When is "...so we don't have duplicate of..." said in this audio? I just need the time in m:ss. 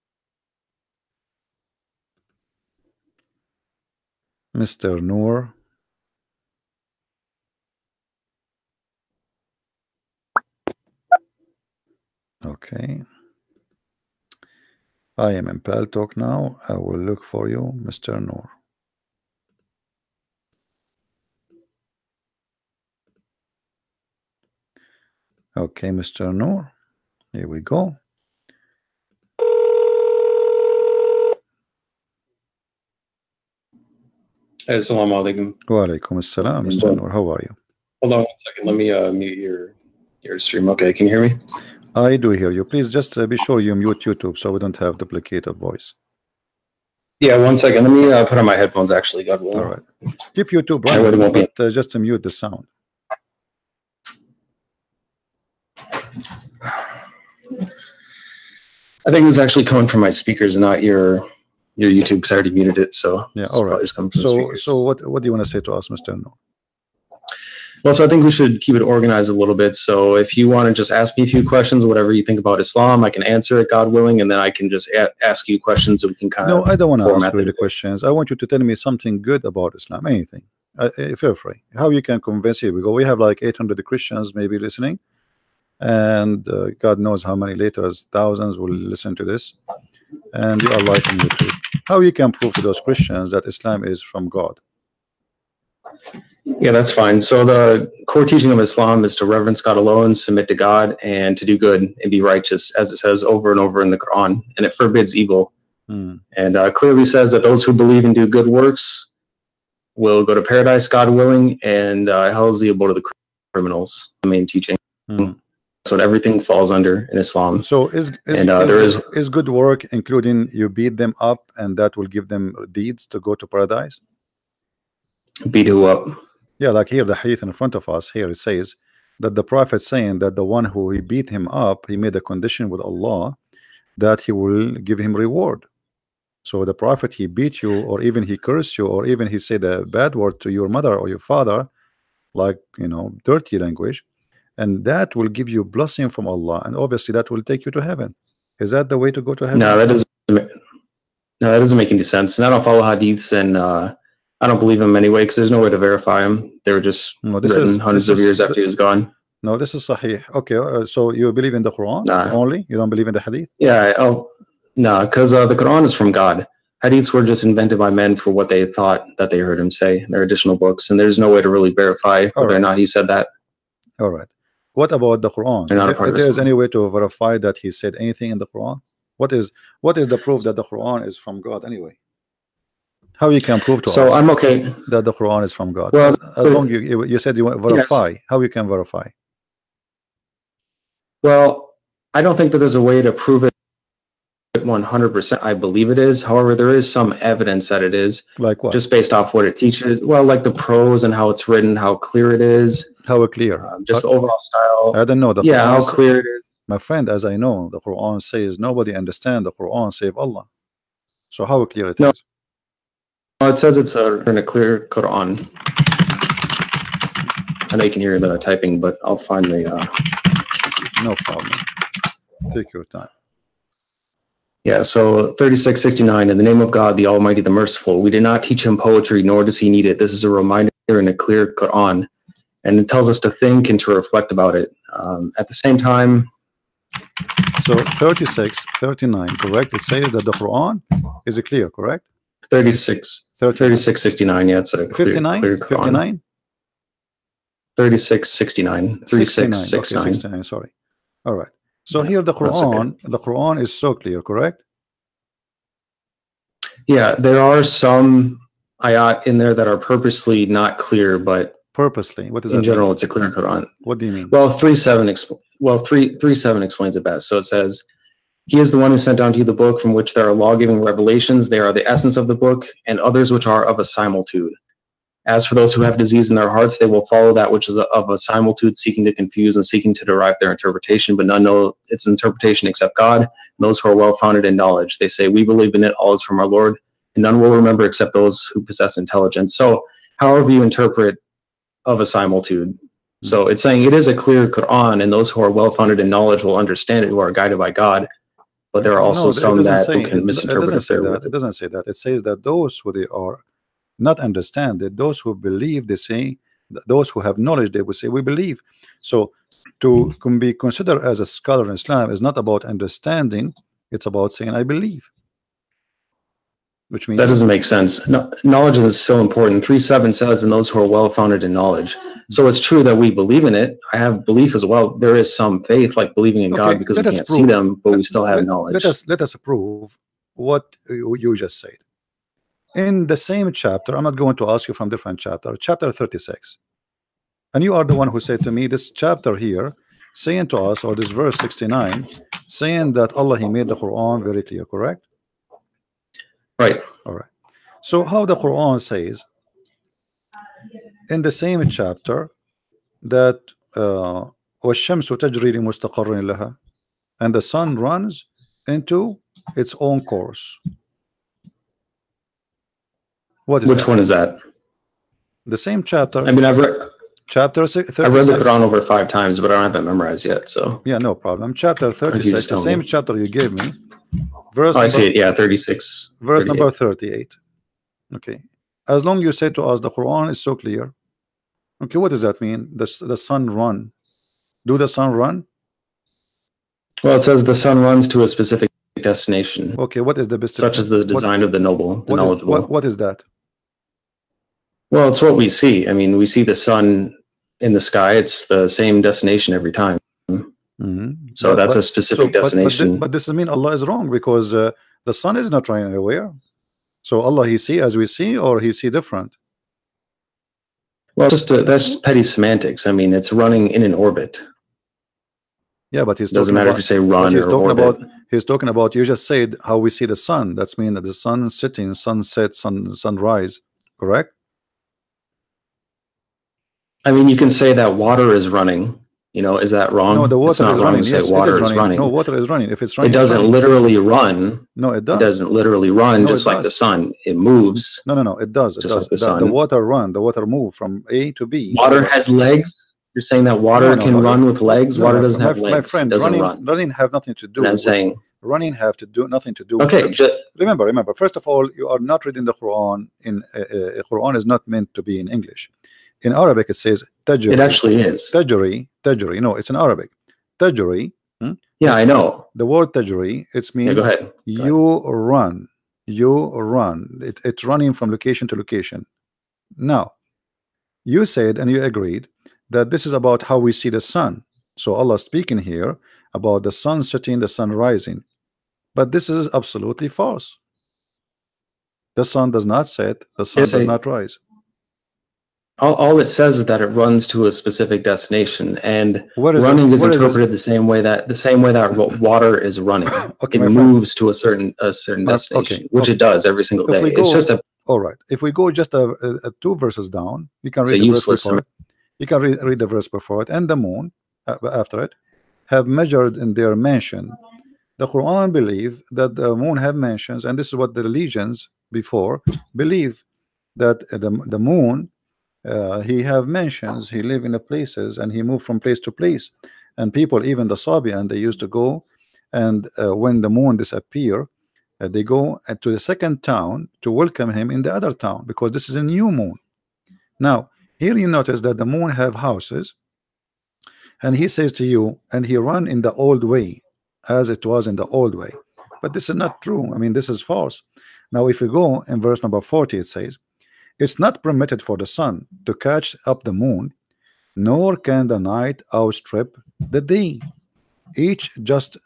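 0:44.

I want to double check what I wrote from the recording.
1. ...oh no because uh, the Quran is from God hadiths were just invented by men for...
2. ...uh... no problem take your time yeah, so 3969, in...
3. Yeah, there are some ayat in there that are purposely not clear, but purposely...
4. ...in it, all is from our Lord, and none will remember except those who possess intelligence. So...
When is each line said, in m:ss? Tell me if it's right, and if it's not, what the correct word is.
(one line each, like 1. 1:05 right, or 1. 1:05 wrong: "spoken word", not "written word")
1. 2:43 right
2. 3:39 wrong: "3669", not "3969"
3. 4:16 right
4. 4:45 right.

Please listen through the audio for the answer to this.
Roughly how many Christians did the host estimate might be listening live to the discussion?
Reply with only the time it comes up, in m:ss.
1:23.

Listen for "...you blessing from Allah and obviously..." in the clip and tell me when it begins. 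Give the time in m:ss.
2:25.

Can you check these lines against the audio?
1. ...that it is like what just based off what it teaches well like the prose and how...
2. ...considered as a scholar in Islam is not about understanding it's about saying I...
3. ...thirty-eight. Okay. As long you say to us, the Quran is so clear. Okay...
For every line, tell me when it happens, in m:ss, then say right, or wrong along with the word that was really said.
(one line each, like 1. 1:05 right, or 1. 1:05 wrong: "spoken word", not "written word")
1. 3:17 right
2. 5:10 right
3. 6:16 right.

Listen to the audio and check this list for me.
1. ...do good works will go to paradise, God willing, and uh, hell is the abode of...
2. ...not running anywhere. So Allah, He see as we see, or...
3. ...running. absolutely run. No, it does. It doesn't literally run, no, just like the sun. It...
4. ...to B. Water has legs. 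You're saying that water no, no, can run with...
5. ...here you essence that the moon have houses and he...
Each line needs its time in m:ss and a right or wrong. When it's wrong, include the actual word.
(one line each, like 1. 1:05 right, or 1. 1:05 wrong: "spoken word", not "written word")
1. 1:48 right
2. 6:45 right
3. 7:13 wrong: "literally", not "absolutely"
4. 7:21 right
5. 8:50 wrong: "notice", not "essence".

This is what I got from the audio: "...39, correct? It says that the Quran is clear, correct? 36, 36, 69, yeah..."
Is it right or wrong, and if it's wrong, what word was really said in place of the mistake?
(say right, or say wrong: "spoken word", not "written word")
right.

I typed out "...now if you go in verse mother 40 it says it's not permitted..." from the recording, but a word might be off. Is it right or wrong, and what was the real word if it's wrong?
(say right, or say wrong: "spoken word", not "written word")
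wrong: "number", not "mother".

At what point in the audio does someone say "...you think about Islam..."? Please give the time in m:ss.
1:12.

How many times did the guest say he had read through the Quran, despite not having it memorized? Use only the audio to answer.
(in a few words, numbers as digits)
over 5 times.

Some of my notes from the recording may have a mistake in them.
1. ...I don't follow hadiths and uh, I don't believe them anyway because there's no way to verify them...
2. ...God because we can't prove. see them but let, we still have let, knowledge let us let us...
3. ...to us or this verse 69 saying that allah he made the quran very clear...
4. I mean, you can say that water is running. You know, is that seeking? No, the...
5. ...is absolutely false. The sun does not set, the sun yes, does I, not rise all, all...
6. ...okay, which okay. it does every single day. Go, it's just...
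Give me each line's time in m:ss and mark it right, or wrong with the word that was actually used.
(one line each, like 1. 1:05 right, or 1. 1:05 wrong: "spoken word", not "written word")
1. 2:32 right
2. 5:26 right
3. 5:40 right
4. 7:07 wrong: "wrong", not "seeking"
5. 7:59 right
6. 8:15 right.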